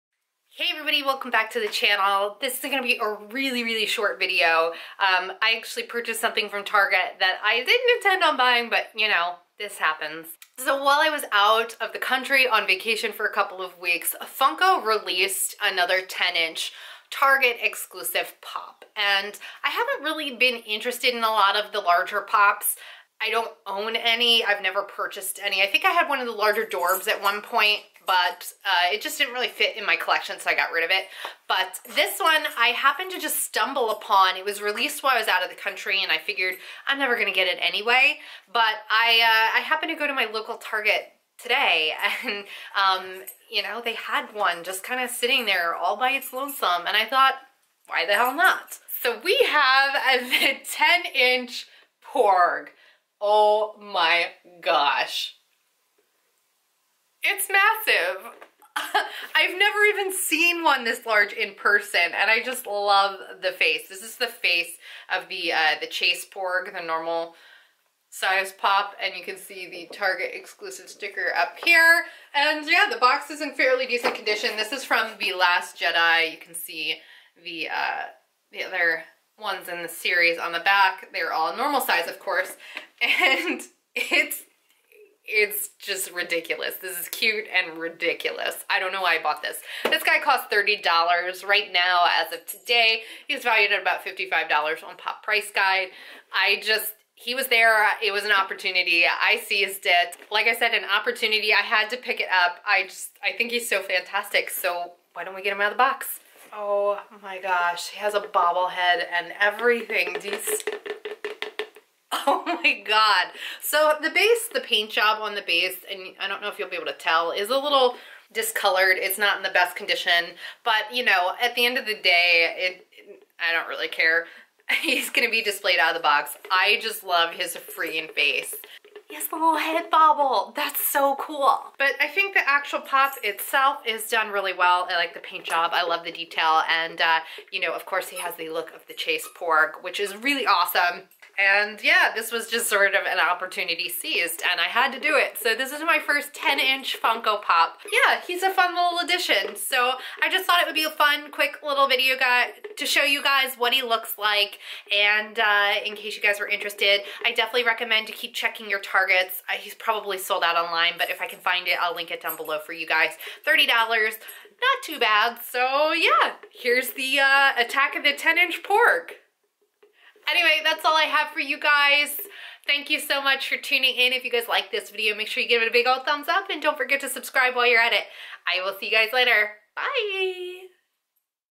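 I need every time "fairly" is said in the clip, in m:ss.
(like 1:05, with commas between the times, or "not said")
1:13.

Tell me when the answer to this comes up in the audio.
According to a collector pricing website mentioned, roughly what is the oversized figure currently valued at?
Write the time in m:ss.
1:34.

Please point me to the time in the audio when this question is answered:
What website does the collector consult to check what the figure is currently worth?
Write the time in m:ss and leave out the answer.
1:34.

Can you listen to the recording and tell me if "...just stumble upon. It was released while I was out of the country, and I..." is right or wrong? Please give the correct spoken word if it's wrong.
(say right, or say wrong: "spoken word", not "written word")
right.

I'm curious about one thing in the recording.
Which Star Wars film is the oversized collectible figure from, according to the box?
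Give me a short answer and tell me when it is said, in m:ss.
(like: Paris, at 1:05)
The Last Jedi, at 1:15.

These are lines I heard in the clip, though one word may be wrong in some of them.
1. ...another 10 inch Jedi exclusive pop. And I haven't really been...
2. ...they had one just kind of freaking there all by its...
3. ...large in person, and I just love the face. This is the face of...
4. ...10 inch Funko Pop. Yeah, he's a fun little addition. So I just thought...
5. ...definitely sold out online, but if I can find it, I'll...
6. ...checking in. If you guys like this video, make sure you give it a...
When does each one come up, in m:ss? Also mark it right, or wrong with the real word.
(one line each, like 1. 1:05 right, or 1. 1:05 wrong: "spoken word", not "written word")
1. 0:15 wrong: "Target", not "Jedi"
2. 0:43 wrong: "sitting", not "freaking"
3. 1:01 right
4. 2:26 right
5. 2:39 wrong: "probably", not "definitely"
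6. 2:53 wrong: "tuning", not "checking".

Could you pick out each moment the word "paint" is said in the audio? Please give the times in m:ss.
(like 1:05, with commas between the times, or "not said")
1:54, 2:15.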